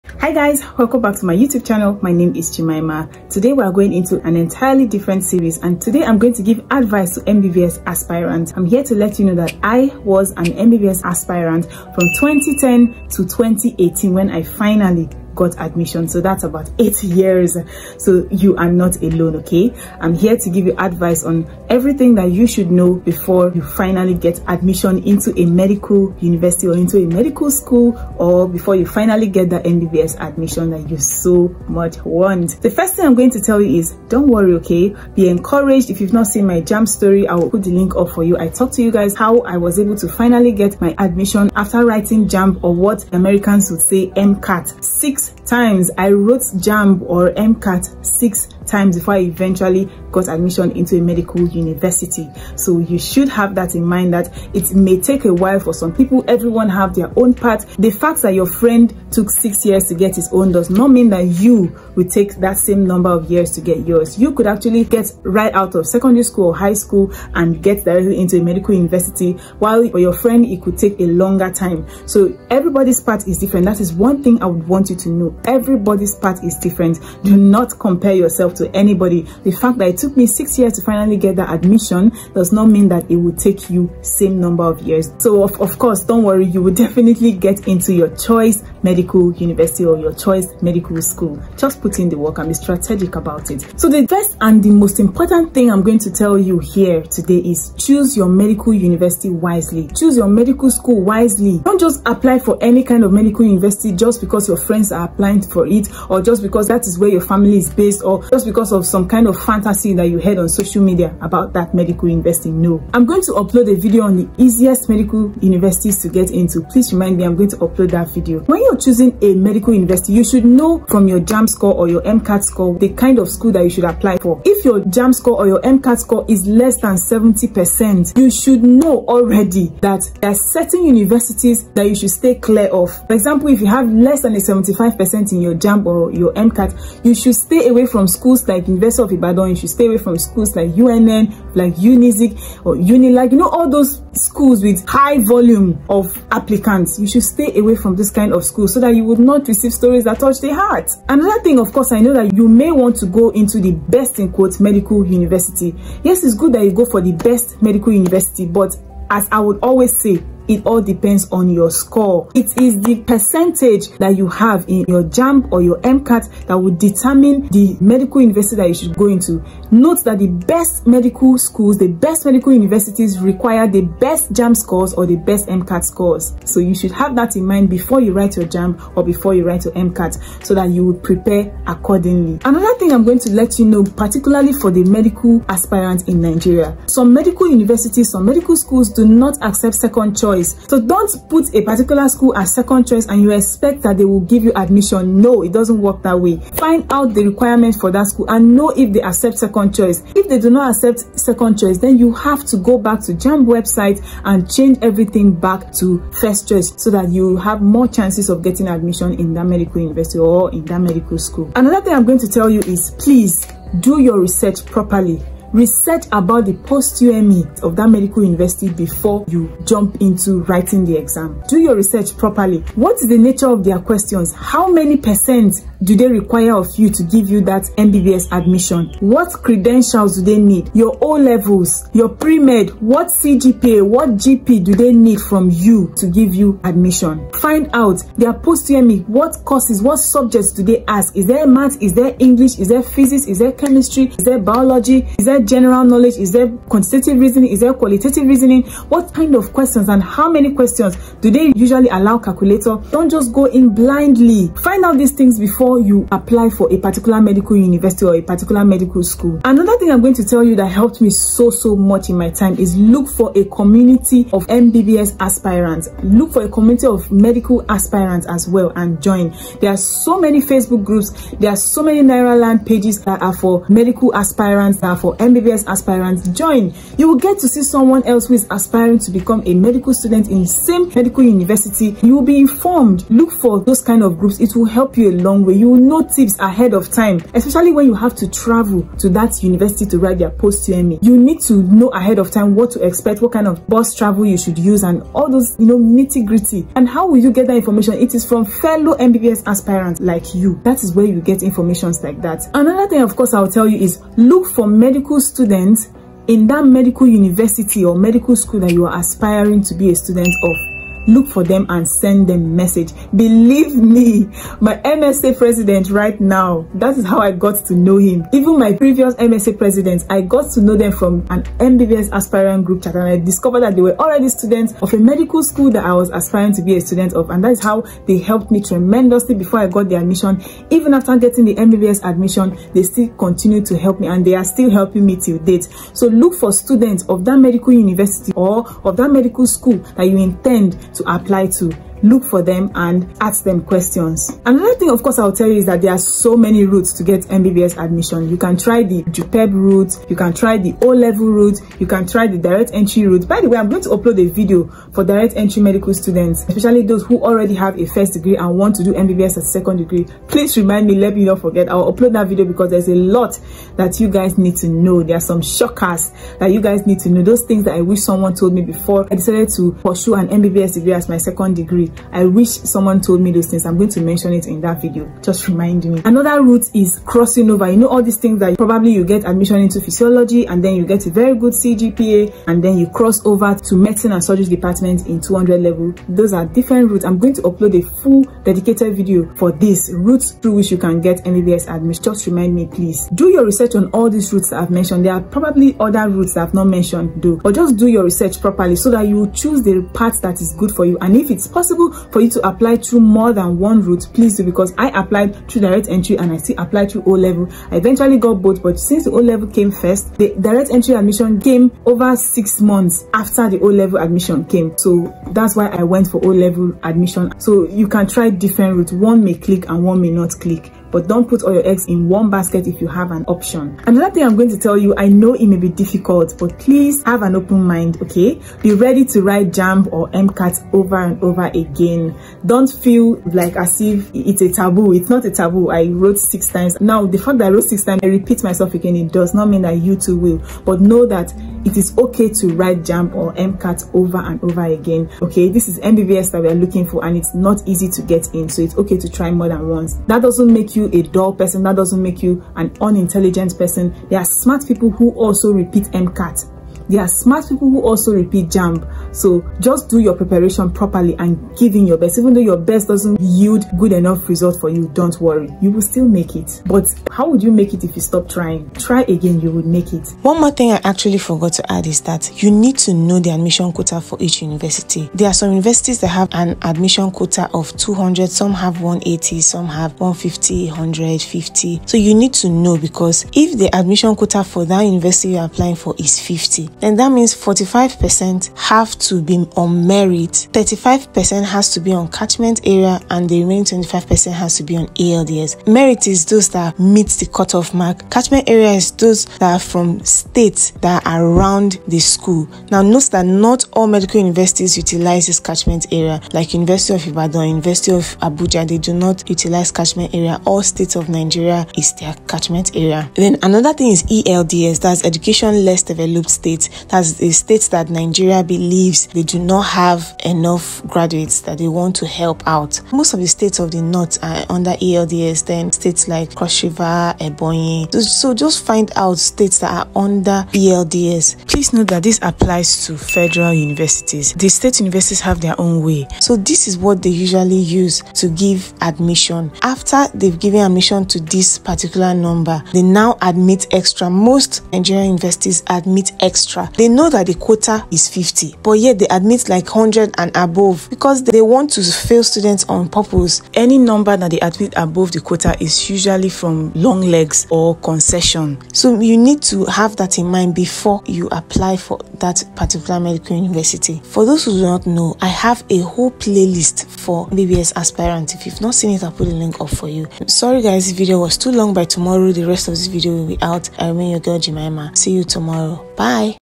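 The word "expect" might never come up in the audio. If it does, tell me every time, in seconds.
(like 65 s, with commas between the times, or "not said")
193 s, 292 s.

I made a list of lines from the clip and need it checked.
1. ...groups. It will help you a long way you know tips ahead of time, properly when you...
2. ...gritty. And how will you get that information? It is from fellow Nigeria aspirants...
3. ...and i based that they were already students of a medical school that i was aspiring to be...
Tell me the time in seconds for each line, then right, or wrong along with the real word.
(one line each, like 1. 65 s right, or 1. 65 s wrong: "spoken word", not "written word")
1. 284 s wrong: "especially", not "properly"
2. 296 s wrong: "MBBS", not "Nigeria"
3. 322 s wrong: "discovered", not "based".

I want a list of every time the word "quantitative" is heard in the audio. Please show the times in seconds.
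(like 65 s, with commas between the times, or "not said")
246 s.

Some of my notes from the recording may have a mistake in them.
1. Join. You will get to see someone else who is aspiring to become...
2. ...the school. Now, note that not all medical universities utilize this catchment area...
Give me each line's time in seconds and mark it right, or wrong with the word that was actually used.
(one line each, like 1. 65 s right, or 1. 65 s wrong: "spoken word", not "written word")
1. 276 s right
2. 501 s right.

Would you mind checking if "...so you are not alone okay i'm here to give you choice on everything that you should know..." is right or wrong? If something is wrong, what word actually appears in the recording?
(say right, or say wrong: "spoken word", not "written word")
wrong: "advice", not "choice".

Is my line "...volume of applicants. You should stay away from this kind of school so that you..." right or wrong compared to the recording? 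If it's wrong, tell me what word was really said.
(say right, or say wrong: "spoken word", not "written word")
right.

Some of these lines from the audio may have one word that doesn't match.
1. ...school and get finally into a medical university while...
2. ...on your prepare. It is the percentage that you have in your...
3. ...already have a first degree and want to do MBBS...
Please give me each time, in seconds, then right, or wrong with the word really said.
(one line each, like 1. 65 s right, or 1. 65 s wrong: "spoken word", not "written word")
1. 66 s wrong: "directly", not "finally"
2. 161 s wrong: "score", not "prepare"
3. 357 s right.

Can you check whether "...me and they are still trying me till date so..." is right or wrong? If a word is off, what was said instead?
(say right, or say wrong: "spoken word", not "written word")
wrong: "helping", not "trying".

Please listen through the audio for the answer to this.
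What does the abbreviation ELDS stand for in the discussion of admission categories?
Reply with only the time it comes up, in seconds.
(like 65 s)
515 s.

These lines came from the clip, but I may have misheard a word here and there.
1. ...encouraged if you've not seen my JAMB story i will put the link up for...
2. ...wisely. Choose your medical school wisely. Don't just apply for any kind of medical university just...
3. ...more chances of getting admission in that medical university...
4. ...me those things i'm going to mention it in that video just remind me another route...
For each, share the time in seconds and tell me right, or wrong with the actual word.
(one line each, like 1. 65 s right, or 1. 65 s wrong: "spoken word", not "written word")
1. 35 s right
2. 99 s right
3. 207 s right
4. 373 s right.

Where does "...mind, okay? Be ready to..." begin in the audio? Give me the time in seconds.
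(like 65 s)
427 s.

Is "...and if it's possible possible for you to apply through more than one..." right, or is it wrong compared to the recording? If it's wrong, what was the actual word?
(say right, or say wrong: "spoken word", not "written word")
right.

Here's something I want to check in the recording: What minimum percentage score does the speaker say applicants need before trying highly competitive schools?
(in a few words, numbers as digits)
75%.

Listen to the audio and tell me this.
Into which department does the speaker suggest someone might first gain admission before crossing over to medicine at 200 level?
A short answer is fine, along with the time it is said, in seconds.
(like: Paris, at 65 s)
Physiology, at 379 s.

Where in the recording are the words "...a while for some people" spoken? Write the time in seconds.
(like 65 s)
55 s.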